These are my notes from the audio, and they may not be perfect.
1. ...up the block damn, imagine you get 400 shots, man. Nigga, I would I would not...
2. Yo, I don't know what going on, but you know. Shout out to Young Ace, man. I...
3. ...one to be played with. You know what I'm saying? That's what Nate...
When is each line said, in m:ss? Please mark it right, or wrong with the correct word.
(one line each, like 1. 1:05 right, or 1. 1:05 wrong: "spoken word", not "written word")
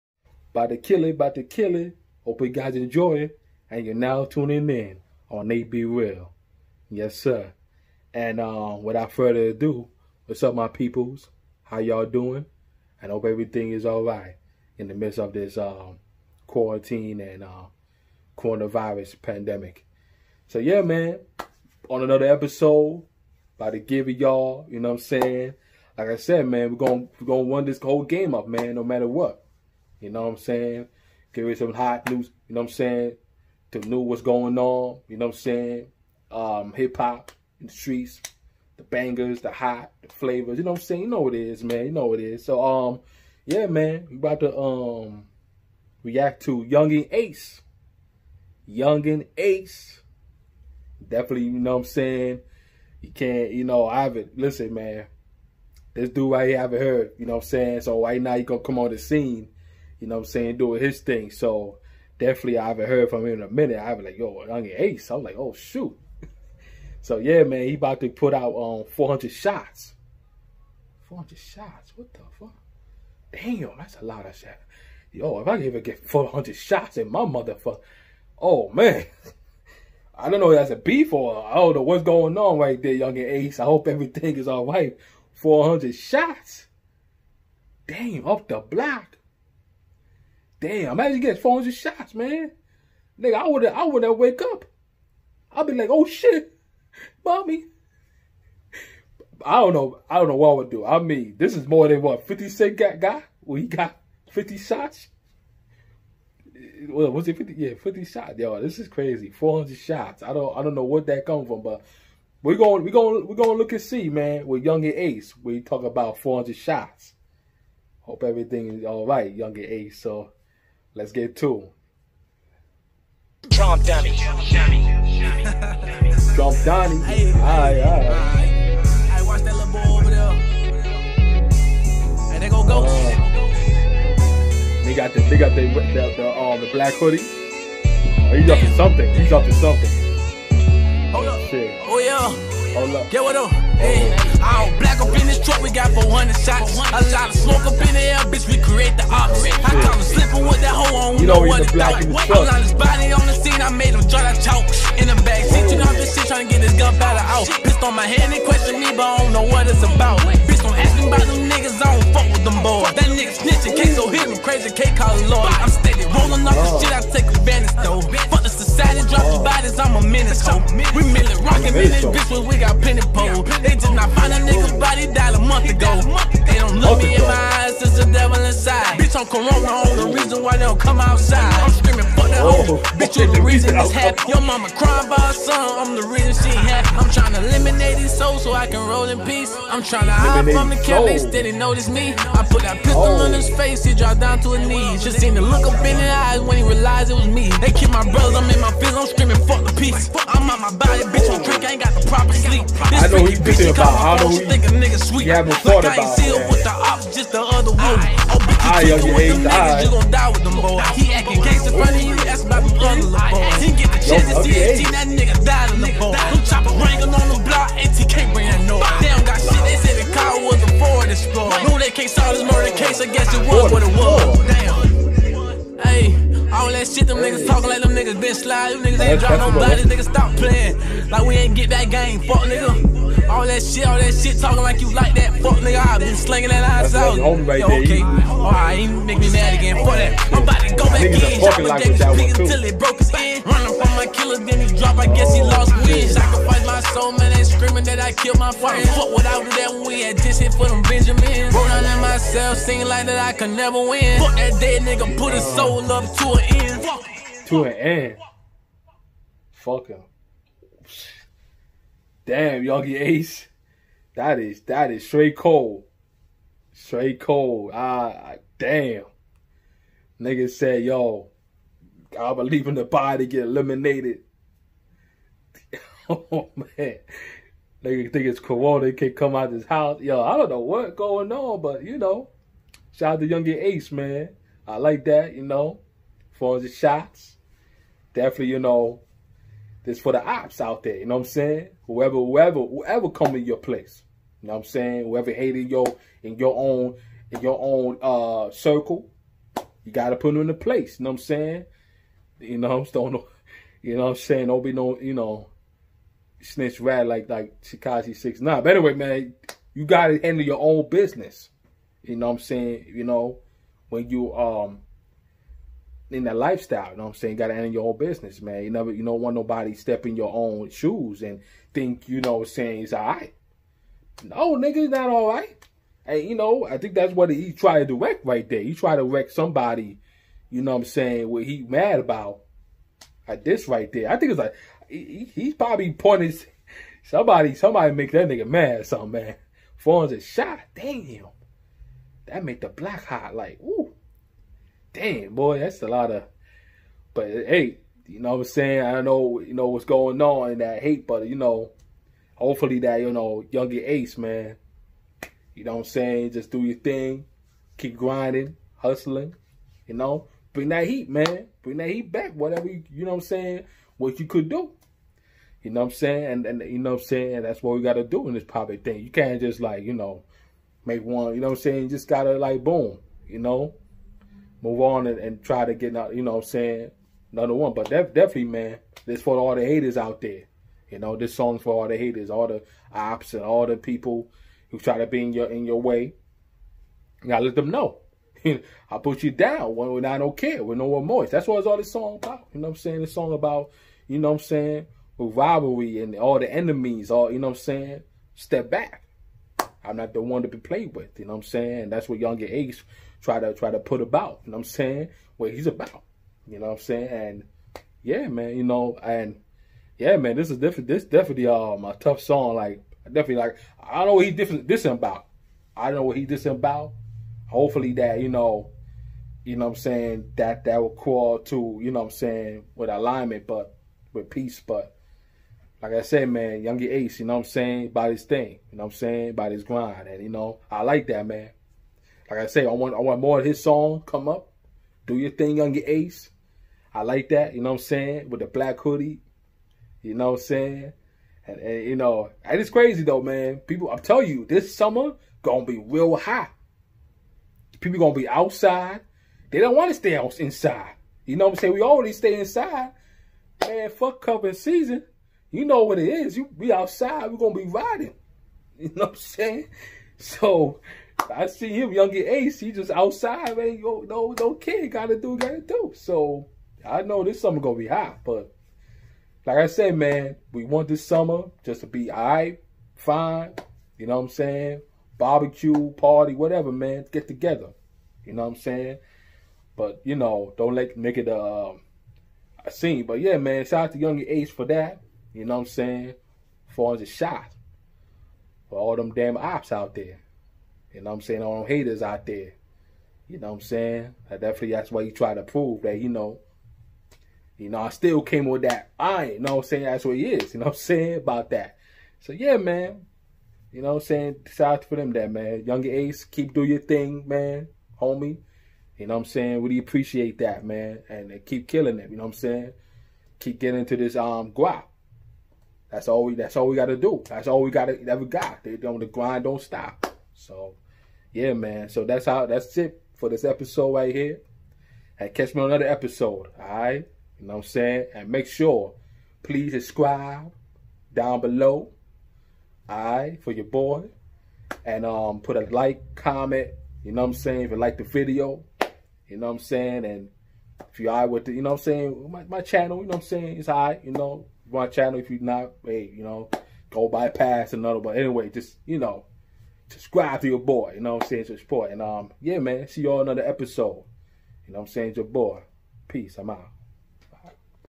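1. 1:28 right
2. 4:40 right
3. 6:40 wrong: "Young", not "Nate".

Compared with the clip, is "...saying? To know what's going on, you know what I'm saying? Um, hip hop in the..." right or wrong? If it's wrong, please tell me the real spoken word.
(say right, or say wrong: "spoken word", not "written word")
right.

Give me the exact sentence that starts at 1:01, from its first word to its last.
So definitely I haven't heard from him in a minute.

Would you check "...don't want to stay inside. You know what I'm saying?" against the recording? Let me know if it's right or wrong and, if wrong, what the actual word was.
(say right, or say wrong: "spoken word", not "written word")
right.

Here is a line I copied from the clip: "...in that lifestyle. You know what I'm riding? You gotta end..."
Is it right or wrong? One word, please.
wrong.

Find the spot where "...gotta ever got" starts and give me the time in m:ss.
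8:37.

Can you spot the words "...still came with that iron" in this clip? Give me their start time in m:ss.
8:17.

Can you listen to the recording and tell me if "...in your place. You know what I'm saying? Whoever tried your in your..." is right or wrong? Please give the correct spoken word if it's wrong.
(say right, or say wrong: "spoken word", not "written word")
wrong: "hated", not "tried".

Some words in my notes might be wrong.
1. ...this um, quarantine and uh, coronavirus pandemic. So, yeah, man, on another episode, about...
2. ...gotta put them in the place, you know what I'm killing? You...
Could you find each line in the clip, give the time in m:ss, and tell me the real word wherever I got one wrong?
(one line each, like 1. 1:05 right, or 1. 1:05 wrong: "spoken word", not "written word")
1. 0:15 right
2. 4:59 wrong: "saying", not "killing".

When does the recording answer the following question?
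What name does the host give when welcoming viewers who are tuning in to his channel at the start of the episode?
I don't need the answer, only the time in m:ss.
0:05.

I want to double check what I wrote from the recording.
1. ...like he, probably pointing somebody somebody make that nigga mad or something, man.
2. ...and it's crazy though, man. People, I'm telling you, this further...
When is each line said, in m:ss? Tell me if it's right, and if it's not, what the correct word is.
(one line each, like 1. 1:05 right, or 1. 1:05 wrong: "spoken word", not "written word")
1. 5:34 right
2. 7:22 wrong: "summer", not "further".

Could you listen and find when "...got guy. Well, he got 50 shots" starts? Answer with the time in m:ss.
1:42.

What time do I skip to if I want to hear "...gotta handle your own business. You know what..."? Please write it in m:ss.
5:09.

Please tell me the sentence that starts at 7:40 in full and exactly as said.
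So I see him, young Ace, he just outside, man.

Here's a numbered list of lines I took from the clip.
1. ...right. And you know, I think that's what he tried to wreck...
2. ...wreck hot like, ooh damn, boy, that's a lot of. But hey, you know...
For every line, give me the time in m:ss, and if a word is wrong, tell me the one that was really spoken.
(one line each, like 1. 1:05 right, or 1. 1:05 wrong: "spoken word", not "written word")
1. 5:25 right
2. 5:42 wrong: "black", not "wreck".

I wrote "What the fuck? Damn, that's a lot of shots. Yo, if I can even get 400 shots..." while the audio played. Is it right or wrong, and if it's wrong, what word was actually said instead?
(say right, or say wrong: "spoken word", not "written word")
right.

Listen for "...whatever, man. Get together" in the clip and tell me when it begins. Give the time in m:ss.
7:56.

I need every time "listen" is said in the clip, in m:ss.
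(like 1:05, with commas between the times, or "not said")
0:54.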